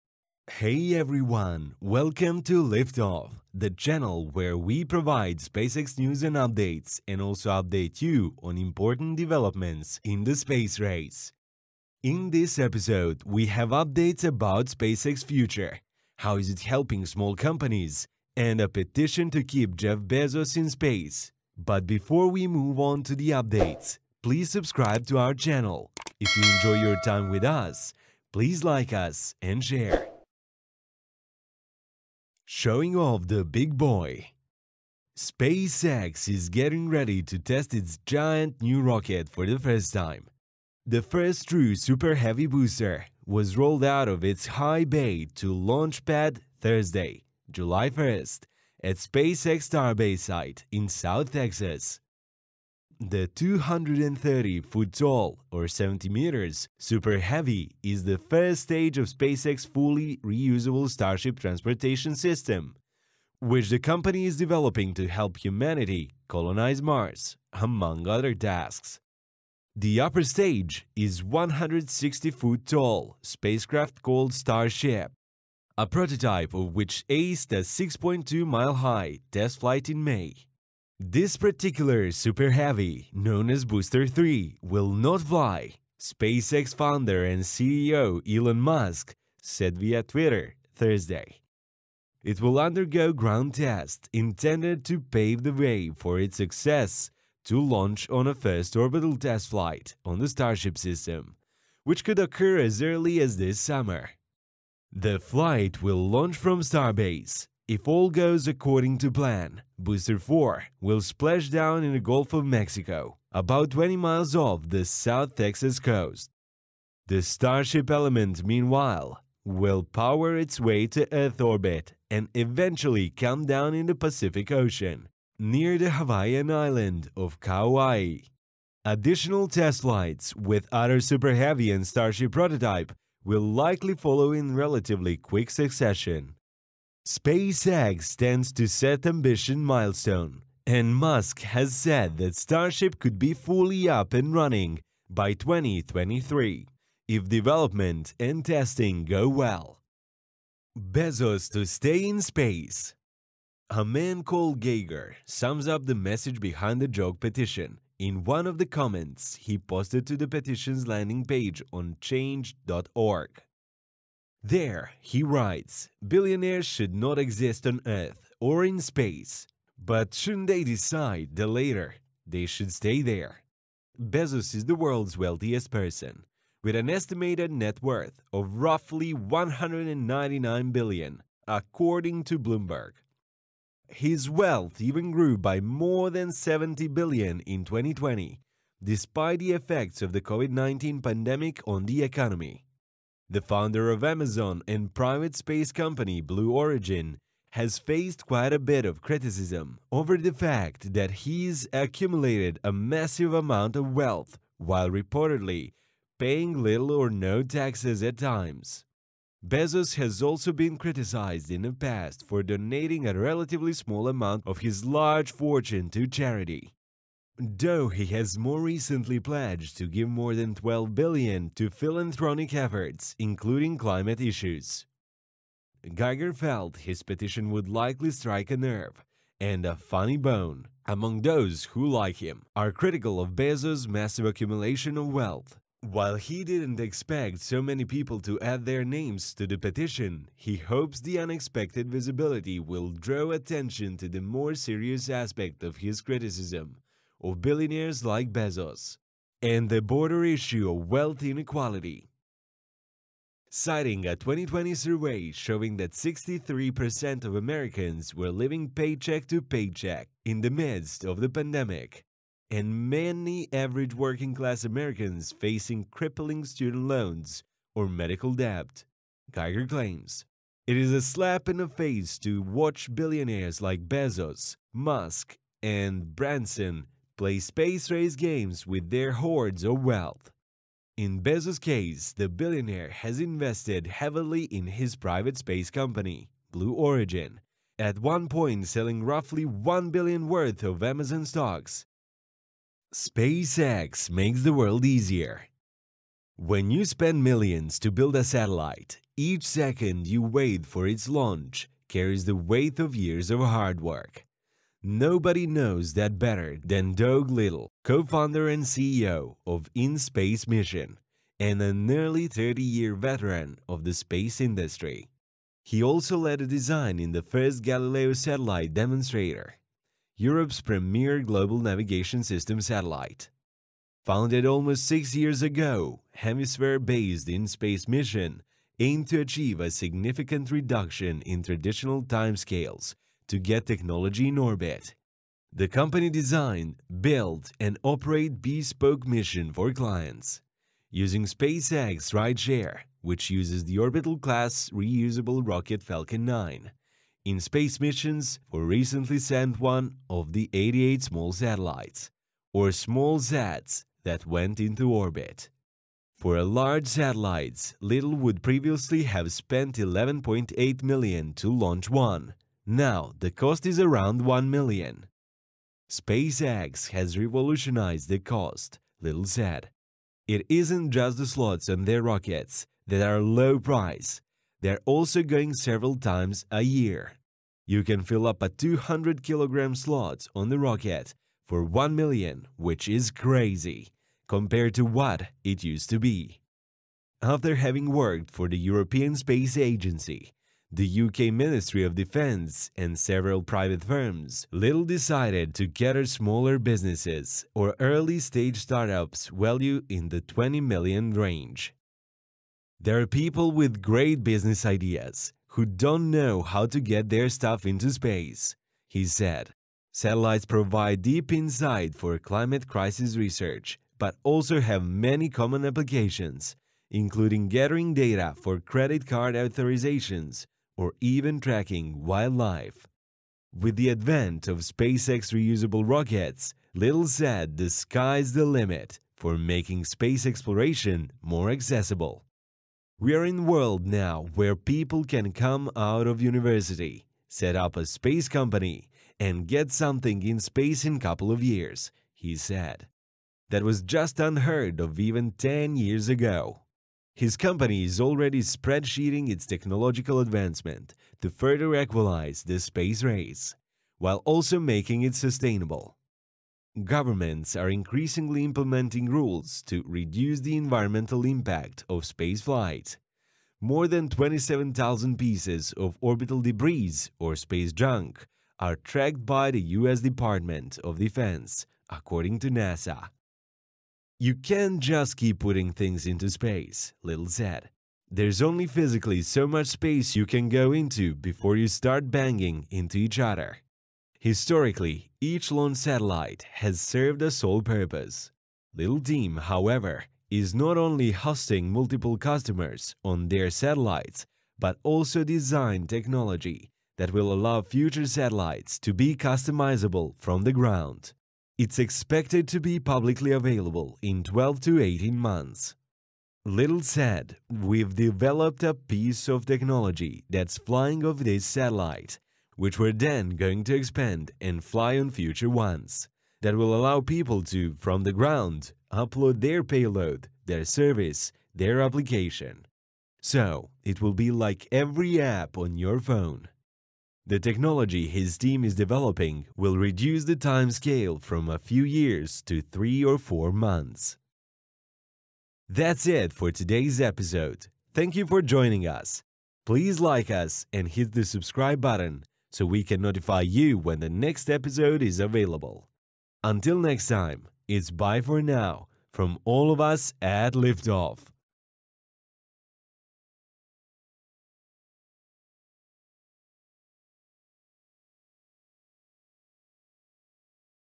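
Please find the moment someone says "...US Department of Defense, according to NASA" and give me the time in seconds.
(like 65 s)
469 s.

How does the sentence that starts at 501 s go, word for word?
It's expected to be publicly available in 12 to 18 months.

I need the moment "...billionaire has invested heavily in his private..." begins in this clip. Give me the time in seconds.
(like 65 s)
282 s.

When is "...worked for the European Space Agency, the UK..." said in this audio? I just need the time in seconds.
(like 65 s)
387 s.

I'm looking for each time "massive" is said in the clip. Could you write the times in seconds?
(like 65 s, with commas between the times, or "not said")
202 s, 233 s.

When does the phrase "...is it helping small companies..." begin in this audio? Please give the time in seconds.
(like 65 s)
16 s.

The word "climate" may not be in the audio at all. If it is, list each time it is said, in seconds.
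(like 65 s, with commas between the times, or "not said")
223 s, 412 s.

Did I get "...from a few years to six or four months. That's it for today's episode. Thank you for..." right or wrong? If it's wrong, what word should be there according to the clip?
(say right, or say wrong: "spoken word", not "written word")
wrong: "three", not "six".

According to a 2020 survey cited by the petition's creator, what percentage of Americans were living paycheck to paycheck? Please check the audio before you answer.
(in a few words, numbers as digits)
63%.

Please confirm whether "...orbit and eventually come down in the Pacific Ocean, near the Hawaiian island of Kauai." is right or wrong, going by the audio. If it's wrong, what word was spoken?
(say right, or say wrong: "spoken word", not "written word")
right.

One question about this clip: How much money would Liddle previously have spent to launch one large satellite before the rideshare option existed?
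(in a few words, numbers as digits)
11.8 million.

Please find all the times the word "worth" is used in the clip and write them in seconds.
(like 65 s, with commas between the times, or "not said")
177 s, 290 s.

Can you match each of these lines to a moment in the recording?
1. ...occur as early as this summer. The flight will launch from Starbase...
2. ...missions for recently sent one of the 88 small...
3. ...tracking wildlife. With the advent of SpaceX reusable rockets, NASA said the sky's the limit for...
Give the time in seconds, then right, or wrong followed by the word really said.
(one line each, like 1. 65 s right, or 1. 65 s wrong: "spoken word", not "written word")
1. 102 s right
2. 347 s right
3. 421 s wrong: "Liddle", not "NASA".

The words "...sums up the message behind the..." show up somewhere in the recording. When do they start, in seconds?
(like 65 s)
155 s.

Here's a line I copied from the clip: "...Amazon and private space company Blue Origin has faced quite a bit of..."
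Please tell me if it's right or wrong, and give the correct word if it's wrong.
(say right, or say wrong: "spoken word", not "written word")
right.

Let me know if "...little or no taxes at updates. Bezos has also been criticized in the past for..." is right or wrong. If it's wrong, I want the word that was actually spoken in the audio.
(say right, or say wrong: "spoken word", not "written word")
wrong: "times", not "updates".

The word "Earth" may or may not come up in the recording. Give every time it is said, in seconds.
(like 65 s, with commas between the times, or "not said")
121 s, 167 s.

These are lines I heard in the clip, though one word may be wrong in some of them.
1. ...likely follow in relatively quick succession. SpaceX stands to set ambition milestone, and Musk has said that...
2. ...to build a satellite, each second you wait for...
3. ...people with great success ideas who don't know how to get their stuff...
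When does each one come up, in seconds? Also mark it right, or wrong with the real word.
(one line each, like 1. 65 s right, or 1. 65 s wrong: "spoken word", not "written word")
1. 133 s right
2. 297 s right
3. 403 s wrong: "business", not "success".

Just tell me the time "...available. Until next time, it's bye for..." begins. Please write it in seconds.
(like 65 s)
545 s.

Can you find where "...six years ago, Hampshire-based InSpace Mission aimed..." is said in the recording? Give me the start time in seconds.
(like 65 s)
324 s.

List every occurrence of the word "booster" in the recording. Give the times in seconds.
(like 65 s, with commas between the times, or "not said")
42 s, 83 s, 109 s.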